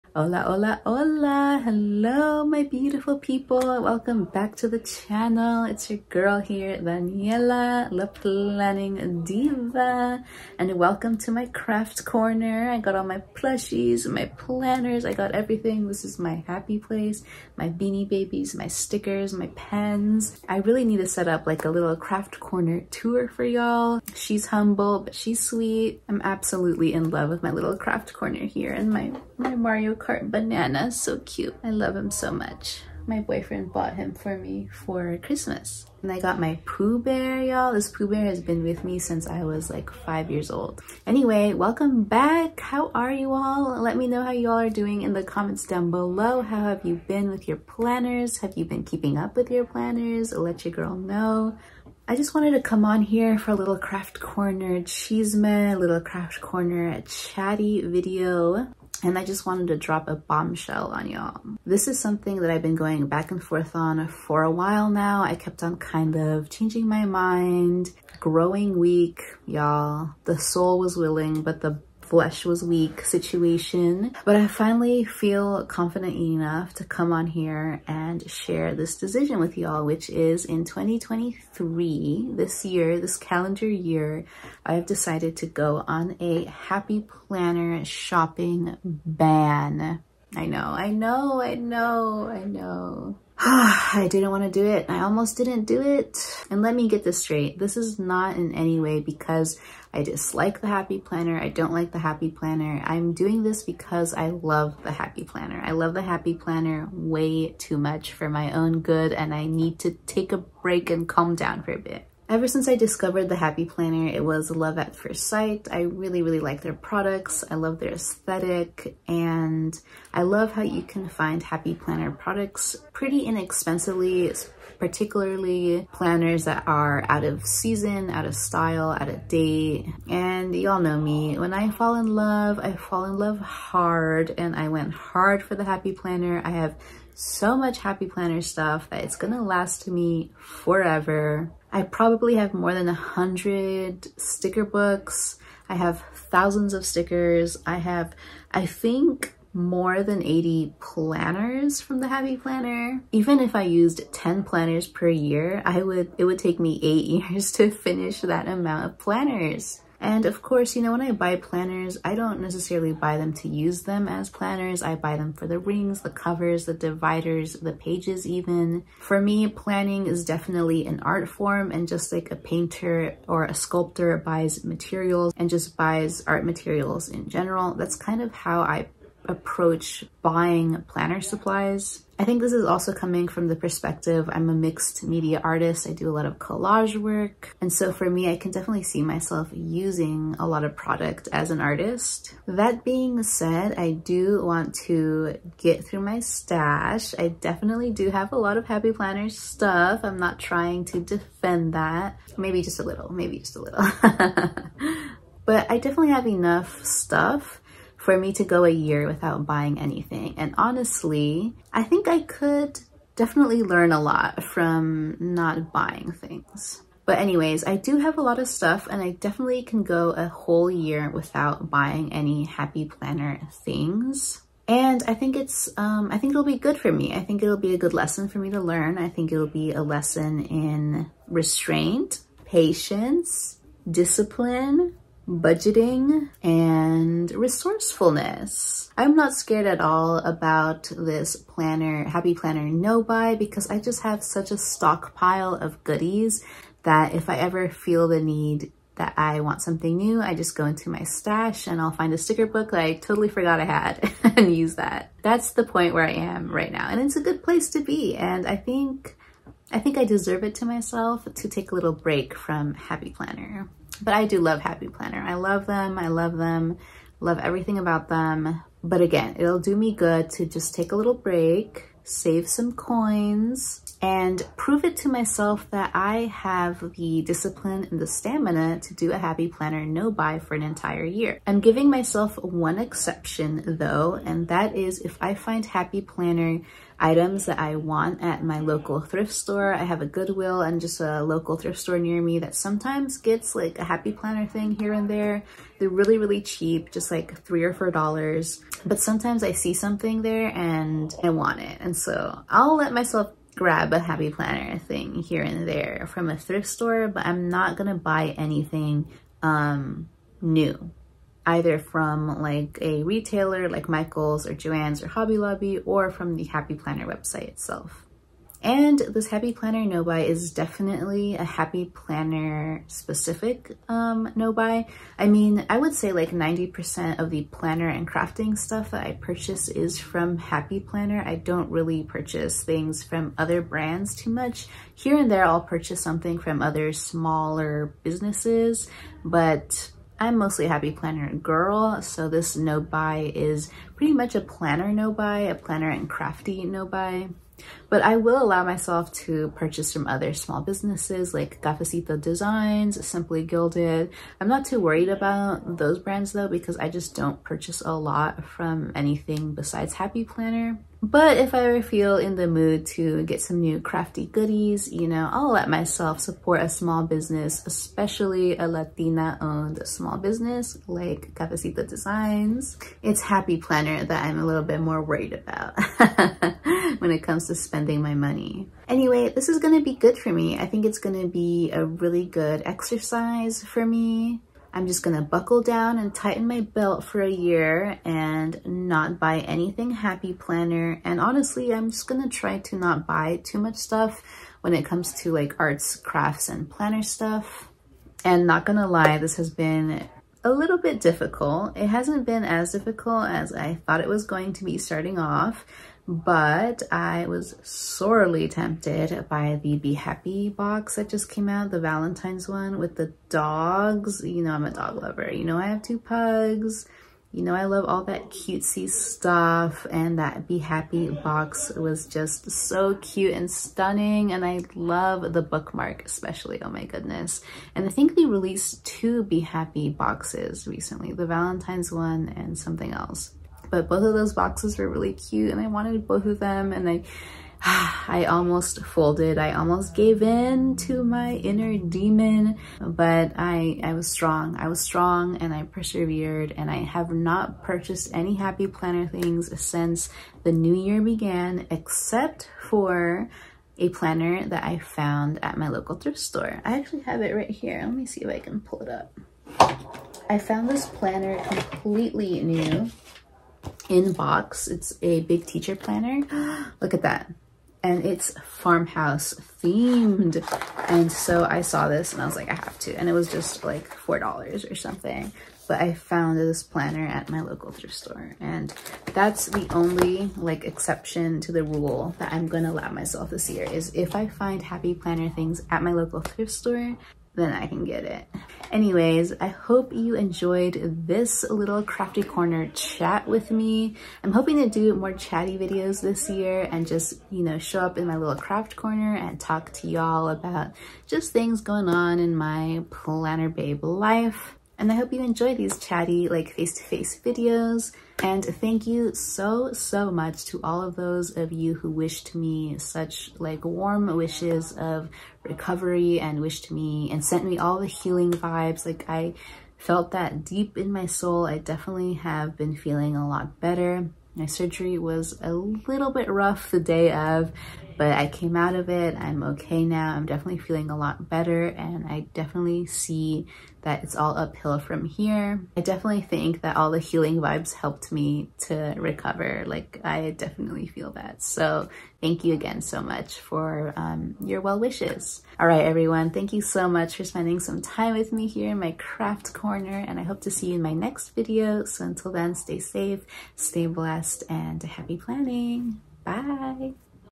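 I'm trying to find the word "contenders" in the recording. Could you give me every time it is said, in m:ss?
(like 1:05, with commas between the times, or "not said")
not said.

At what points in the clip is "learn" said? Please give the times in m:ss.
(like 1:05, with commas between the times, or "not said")
3:33, 3:48.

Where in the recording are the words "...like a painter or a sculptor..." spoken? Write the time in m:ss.
2:52.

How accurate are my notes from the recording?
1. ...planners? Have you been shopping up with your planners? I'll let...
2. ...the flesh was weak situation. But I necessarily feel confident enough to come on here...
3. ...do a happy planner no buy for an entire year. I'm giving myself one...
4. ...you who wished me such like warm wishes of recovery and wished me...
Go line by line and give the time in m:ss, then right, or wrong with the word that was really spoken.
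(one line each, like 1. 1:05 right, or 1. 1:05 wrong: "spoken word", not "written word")
1. 0:47 wrong: "keeping", not "shopping"
2. 1:11 wrong: "finally", not "necessarily"
3. 4:38 right
4. 8:31 right.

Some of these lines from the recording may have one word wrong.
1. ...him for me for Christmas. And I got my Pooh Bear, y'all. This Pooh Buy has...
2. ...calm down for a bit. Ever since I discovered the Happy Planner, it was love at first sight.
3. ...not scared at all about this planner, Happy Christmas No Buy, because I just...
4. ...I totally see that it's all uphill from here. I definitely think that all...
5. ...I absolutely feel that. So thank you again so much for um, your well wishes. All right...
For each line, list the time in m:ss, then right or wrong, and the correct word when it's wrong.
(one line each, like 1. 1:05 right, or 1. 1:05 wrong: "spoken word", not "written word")
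1. 0:33 wrong: "Bear", not "Buy"
2. 1:51 right
3. 3:59 wrong: "Planner", not "Christmas"
4. 8:52 wrong: "definitely", not "totally"
5. 9:00 wrong: "definitely", not "absolutely".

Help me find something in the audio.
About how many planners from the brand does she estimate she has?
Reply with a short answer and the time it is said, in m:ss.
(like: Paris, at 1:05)
80, at 2:29.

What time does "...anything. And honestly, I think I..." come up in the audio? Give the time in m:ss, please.
3:29.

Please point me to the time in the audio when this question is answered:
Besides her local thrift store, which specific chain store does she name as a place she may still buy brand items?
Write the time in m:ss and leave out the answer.
4:50.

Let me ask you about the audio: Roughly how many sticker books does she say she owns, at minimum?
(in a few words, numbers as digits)
100.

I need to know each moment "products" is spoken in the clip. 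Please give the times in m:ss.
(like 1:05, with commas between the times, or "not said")
1:56, 2:02, 3:10.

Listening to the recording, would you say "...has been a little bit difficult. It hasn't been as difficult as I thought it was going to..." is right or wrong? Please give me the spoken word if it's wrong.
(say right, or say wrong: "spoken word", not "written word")
right.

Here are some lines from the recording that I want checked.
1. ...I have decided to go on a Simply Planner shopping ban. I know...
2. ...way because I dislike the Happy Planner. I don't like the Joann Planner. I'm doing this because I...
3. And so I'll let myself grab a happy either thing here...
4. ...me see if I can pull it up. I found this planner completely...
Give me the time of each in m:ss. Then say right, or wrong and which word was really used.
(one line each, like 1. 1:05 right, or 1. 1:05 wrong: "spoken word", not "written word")
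1. 1:24 wrong: "Happy", not "Simply"
2. 1:38 wrong: "Happy", not "Joann"
3. 5:01 wrong: "planner", not "either"
4. 7:37 right.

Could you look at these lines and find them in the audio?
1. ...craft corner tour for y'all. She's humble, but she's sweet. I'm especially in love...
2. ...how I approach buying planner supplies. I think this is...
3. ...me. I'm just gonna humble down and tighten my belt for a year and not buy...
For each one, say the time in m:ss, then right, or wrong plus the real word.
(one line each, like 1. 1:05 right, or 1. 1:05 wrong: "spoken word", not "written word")
1. 0:21 wrong: "absolutely", not "especially"
2. 2:58 right
3. 6:23 wrong: "buckle", not "humble".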